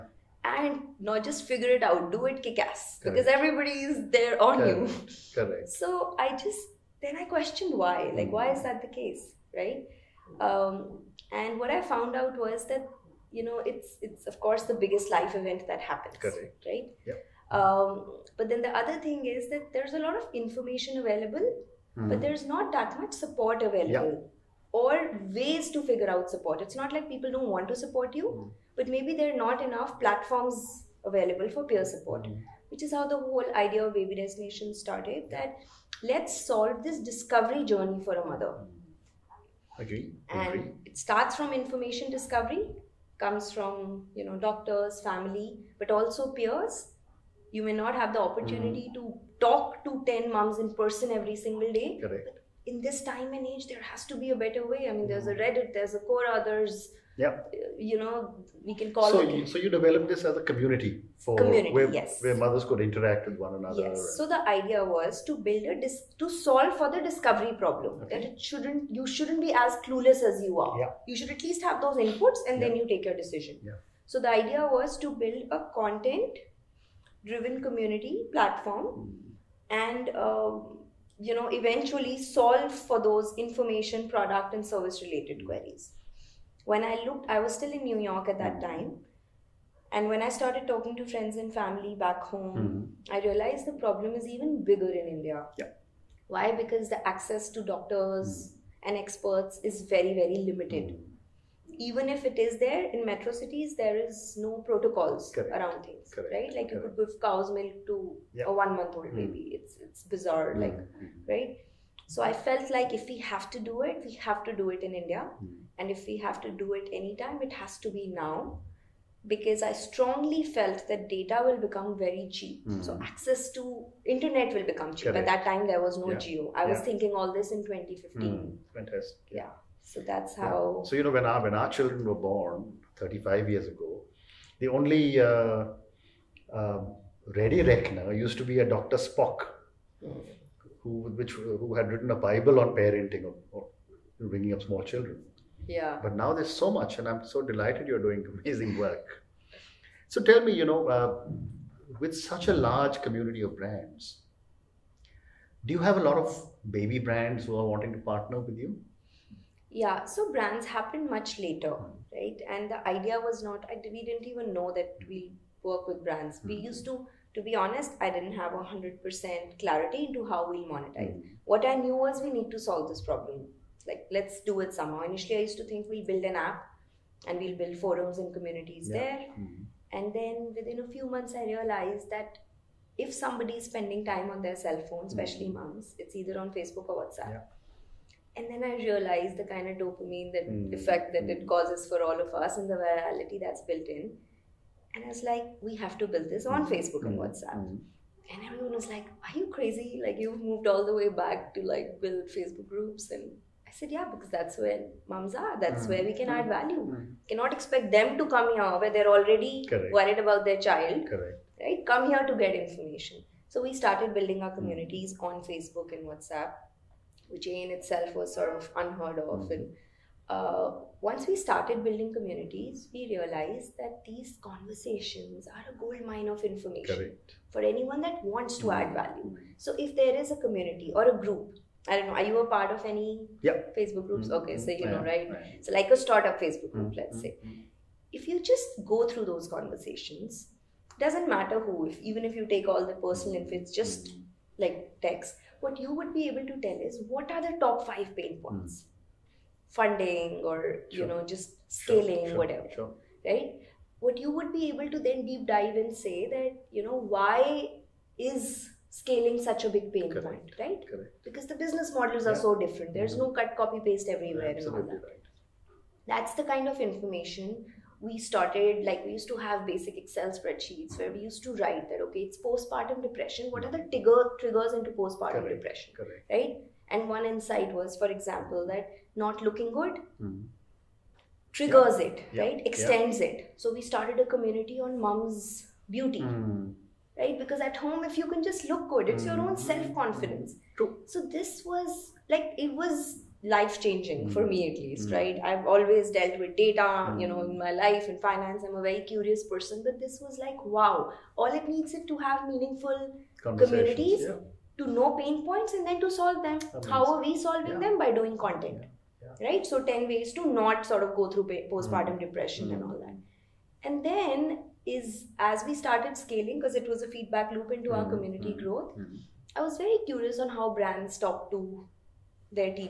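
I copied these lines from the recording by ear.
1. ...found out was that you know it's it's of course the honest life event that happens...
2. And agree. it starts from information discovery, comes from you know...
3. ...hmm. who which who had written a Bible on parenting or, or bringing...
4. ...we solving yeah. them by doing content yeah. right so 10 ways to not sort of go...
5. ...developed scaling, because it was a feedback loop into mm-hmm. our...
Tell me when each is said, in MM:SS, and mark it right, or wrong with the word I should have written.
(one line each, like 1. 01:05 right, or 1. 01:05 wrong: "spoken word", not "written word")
1. 00:11 wrong: "biggest", not "honest"
2. 00:40 right
3. 02:20 right
4. 05:07 right
5. 05:15 wrong: "started", not "developed".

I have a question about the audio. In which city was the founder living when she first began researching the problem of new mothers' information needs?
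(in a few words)
New York.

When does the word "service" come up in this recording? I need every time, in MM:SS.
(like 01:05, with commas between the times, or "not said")
01:24.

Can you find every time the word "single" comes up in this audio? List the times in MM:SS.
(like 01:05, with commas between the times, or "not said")
00:51.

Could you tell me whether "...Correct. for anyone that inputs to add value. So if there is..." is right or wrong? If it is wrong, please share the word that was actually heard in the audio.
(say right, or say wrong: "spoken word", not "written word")
wrong: "wants", not "inputs".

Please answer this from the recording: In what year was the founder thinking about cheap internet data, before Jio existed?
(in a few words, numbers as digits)
2015.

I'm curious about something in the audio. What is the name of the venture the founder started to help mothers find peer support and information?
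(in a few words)
Baby Destination.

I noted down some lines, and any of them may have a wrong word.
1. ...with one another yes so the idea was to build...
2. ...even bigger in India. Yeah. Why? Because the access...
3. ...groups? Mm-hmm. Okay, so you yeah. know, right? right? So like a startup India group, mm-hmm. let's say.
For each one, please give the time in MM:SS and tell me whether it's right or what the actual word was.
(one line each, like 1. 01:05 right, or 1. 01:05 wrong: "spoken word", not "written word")
1. 01:03 right
2. 01:34 right
3. 03:54 wrong: "Facebook", not "India".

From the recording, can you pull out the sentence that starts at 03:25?
That's mm where we can mm add hmm.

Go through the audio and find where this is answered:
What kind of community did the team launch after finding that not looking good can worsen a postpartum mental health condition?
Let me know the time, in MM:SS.
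04:44.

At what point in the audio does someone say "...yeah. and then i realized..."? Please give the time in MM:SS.
03:07.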